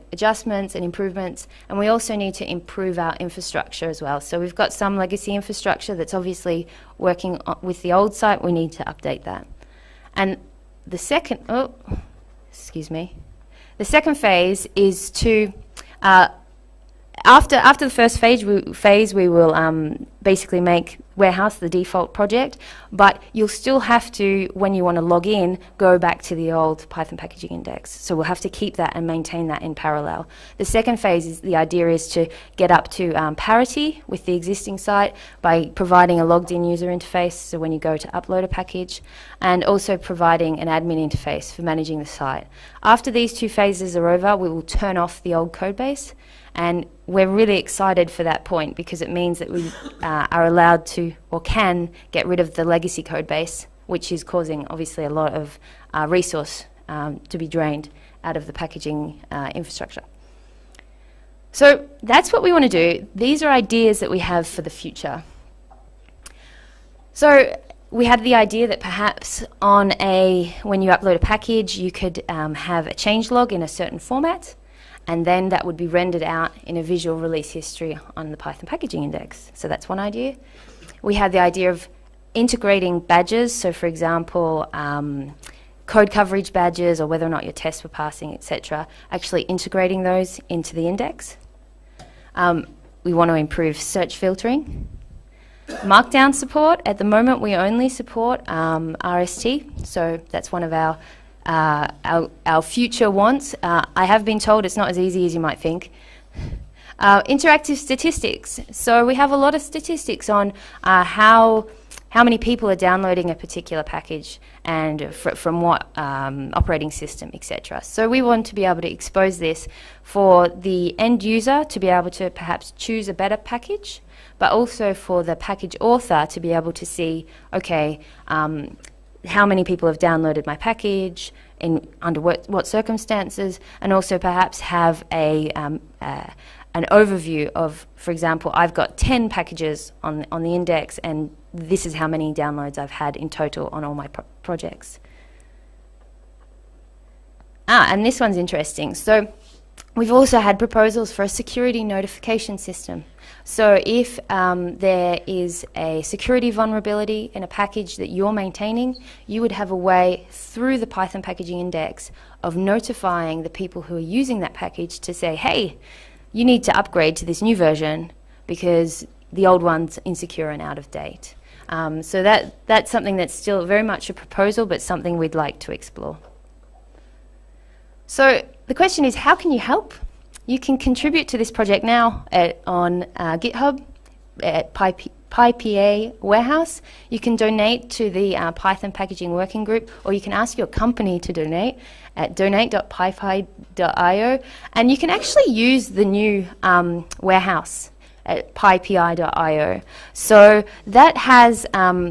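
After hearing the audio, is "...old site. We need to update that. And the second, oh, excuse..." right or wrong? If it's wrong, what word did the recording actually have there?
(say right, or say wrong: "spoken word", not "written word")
right.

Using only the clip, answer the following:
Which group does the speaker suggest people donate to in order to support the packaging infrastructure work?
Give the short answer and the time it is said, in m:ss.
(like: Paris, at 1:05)
Python Packaging Working Group, at 3:08.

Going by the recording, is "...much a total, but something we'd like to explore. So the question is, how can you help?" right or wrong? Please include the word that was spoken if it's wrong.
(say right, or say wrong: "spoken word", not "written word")
wrong: "proposal", not "total".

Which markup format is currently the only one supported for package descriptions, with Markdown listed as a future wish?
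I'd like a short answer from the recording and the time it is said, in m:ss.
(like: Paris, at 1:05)
RST, at 1:39.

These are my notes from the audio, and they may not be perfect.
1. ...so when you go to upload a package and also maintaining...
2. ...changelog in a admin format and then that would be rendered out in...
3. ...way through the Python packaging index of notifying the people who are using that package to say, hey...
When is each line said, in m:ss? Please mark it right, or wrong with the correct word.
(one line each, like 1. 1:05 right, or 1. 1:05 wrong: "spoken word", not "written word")
1. 0:37 wrong: "providing", not "maintaining"
2. 1:12 wrong: "certain", not "admin"
3. 2:39 right.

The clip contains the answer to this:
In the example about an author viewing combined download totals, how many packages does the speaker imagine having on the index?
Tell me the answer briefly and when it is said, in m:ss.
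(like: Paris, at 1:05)
10, at 2:18.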